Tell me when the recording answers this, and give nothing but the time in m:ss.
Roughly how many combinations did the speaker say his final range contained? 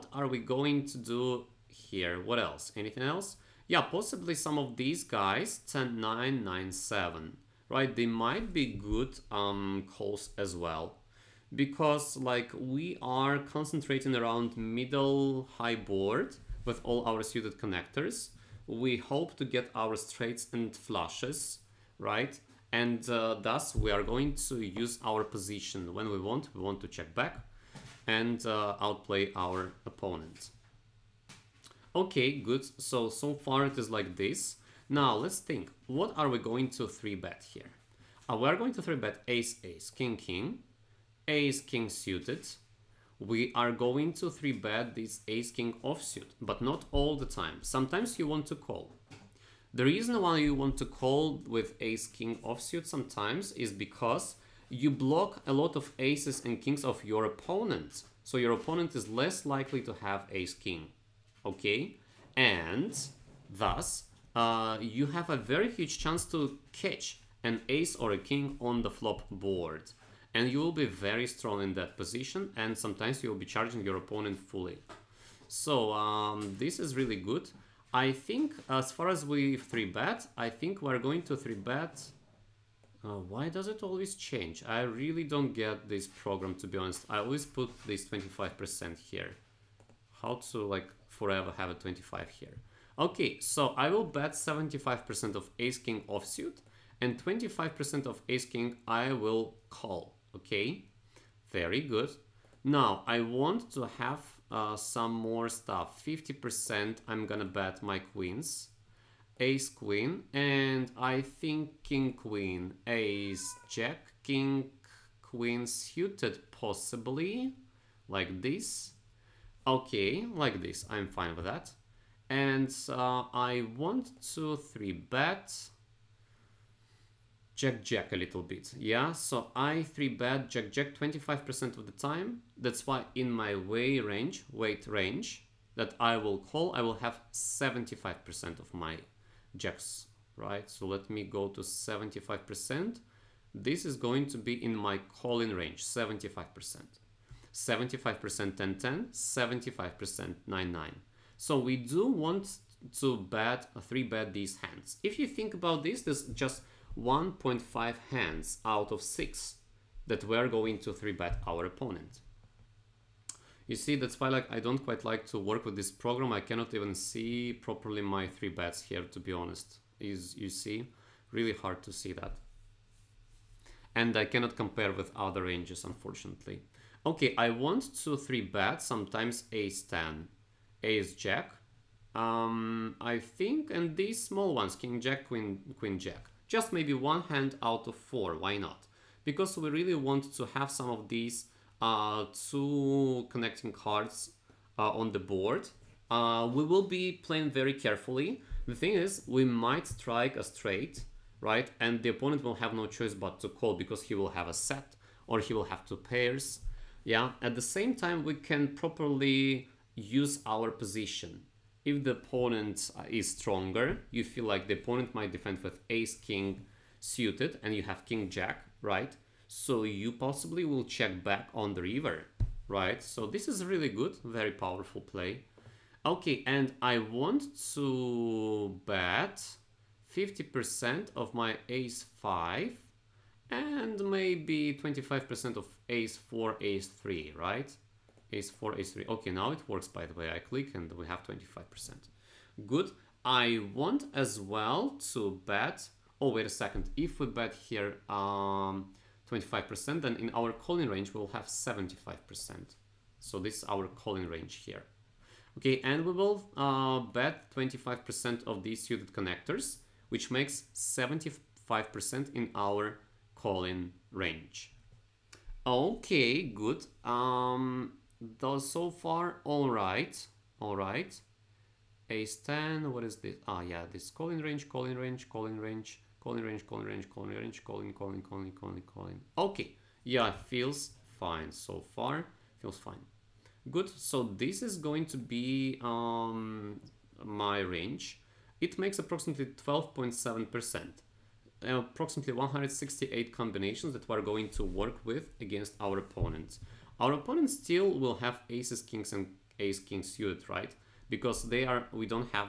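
4:52.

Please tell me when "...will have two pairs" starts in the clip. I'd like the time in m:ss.
3:25.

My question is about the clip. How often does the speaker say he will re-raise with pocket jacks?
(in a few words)
25%.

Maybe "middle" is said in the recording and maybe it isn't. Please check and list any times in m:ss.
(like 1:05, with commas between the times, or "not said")
0:14.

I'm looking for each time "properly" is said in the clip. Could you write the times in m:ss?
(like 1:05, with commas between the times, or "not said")
2:47, 3:28.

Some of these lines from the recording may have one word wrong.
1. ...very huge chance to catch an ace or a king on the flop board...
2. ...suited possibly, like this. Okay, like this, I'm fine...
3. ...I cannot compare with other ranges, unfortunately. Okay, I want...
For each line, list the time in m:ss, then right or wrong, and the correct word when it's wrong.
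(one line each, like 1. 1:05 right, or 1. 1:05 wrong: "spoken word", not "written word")
1. 1:05 right
2. 1:55 right
3. 2:54 right.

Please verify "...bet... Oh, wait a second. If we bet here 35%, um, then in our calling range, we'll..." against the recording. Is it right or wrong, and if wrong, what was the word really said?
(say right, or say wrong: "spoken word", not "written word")
wrong: "25", not "35".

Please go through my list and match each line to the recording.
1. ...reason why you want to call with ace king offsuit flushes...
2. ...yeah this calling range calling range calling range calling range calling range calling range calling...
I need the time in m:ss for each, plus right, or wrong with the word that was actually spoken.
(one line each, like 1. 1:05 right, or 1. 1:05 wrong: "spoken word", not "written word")
1. 0:49 wrong: "sometimes", not "flushes"
2. 4:33 right.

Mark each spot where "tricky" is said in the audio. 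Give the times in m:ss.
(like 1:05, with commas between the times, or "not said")
not said.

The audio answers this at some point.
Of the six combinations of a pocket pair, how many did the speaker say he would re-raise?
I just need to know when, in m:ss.
2:36.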